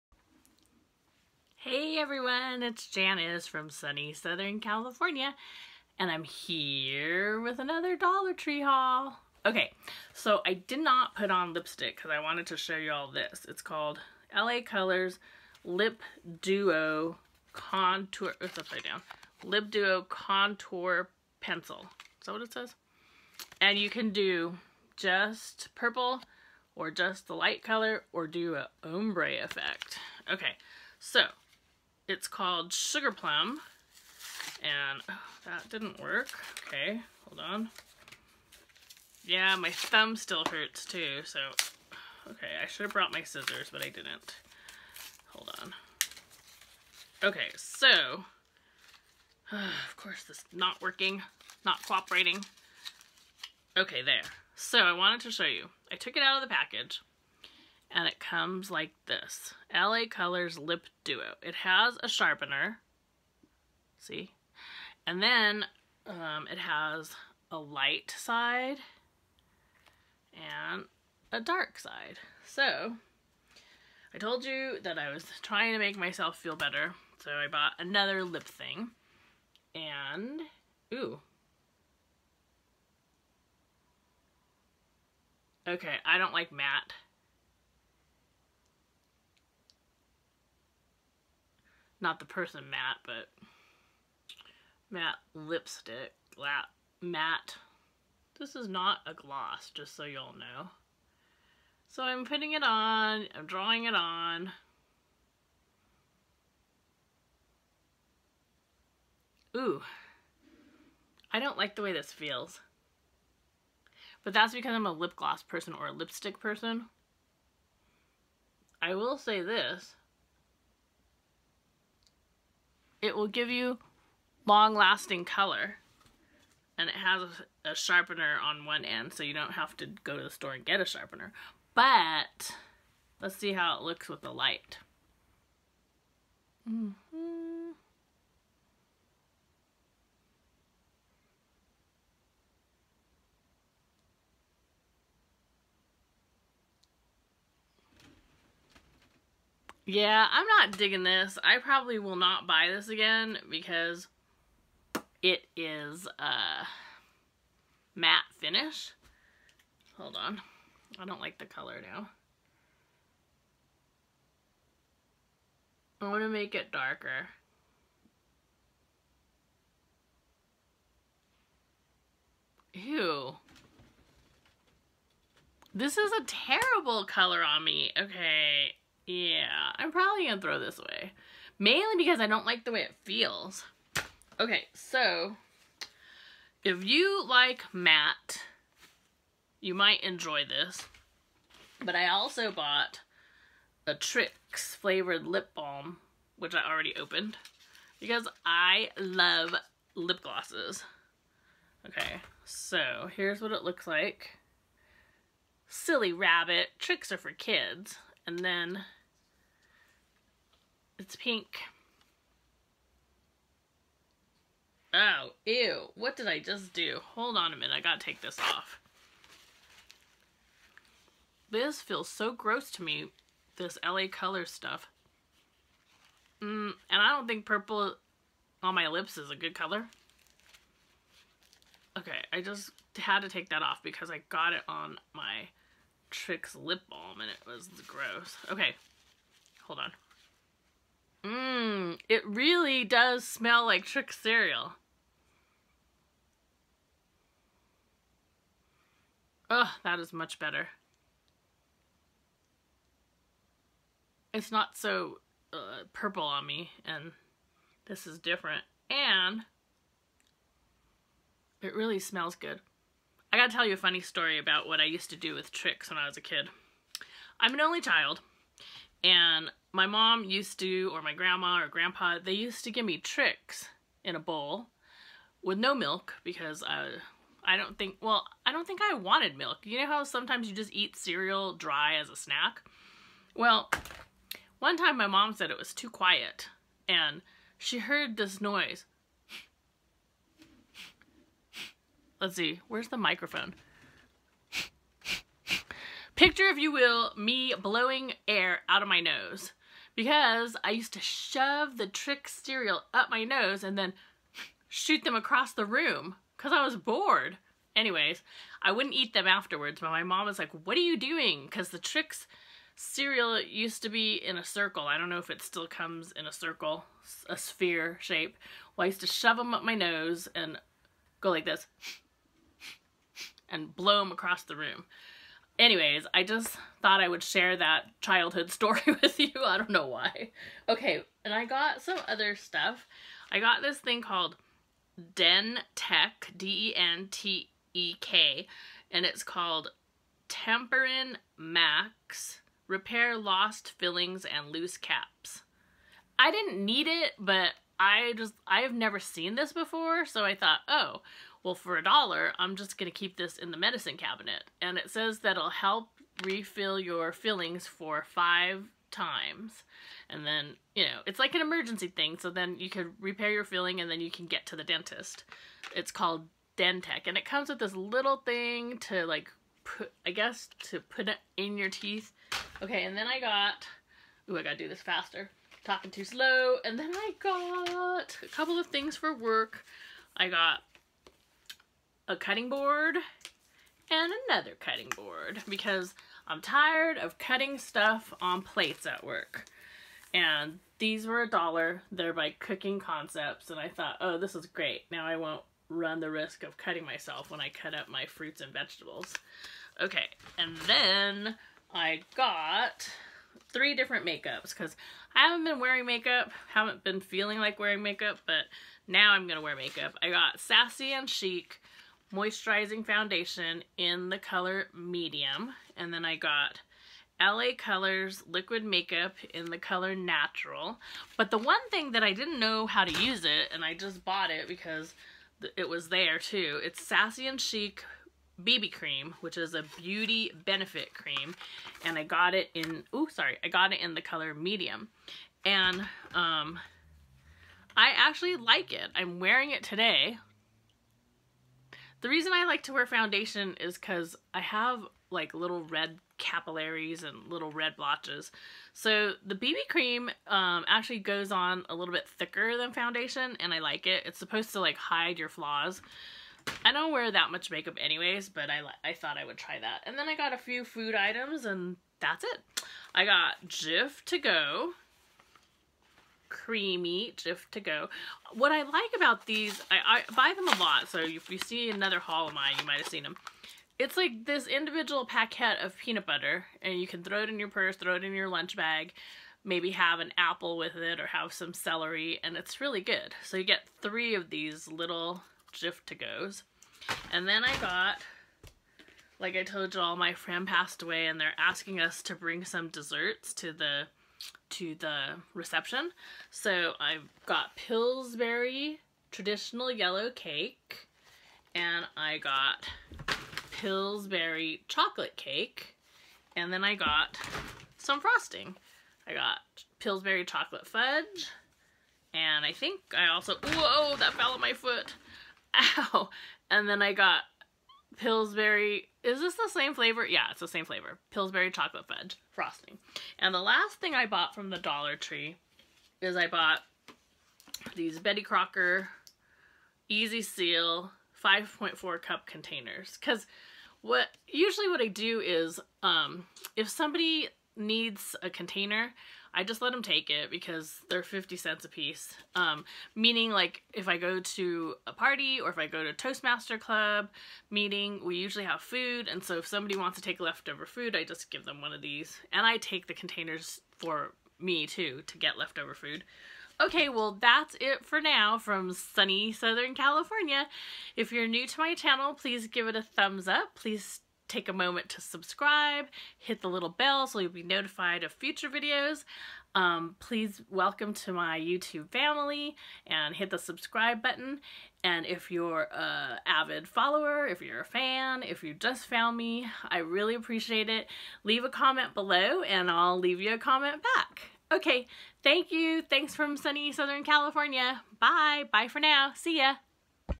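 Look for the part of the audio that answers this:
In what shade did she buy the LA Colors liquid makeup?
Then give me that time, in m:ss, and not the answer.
6:59.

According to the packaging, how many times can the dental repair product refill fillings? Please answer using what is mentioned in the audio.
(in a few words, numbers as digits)
5.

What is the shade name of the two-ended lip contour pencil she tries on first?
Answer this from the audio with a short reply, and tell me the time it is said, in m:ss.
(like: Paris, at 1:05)
Sugar Plum, at 0:32.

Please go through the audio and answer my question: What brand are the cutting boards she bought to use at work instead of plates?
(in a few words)
Cooking Concepts.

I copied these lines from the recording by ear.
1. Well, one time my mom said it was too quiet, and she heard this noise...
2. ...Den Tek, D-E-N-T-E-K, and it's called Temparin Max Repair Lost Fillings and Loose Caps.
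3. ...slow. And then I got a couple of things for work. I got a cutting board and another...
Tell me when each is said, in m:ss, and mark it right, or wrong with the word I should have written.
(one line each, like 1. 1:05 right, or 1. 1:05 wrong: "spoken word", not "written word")
1. 4:43 right
2. 5:35 right
3. 6:16 right.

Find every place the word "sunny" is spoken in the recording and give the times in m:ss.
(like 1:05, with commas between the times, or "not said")
0:03, 9:18, 9:46.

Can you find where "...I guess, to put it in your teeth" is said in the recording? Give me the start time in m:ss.
6:10.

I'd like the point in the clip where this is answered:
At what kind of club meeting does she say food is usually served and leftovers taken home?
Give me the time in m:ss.
9:05.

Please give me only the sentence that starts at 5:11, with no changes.
Because the Trix cereal used to be in a circle.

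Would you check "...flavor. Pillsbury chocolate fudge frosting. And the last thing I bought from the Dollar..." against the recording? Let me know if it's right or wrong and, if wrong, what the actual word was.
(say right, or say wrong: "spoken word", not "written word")
right.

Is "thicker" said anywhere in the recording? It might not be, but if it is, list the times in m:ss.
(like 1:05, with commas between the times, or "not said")
7:32.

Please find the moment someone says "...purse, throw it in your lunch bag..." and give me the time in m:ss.
7:57.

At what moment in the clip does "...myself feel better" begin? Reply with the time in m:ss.
1:15.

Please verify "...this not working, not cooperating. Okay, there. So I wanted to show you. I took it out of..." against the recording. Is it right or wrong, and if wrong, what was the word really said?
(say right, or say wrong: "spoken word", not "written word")
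right.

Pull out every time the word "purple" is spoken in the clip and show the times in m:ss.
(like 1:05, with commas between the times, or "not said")
0:25, 3:47, 4:15.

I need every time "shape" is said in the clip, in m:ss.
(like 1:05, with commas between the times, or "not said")
5:17.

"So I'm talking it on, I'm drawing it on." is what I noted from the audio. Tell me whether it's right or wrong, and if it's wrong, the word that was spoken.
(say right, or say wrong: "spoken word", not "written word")
wrong: "putting", not "talking".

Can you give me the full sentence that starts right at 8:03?
So you get three of these little Jif to goes.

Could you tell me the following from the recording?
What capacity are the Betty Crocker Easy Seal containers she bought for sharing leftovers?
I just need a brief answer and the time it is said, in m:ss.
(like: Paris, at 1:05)
5.4 cups, at 8:51.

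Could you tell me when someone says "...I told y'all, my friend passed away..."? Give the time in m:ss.
8:09.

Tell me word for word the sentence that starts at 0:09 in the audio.
Okay, so I did not put on lipstick because I wanted to show you all this.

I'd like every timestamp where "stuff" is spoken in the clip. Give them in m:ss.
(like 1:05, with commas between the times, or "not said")
3:44, 5:32, 6:27.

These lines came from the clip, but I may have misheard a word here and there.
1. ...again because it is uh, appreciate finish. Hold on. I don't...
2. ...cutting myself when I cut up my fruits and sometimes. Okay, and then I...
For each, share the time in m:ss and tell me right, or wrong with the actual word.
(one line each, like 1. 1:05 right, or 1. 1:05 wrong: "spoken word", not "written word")
1. 2:32 wrong: "matte", not "appreciate"
2. 6:36 wrong: "vegetables", not "sometimes".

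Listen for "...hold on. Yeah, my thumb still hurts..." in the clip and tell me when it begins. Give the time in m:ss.
0:37.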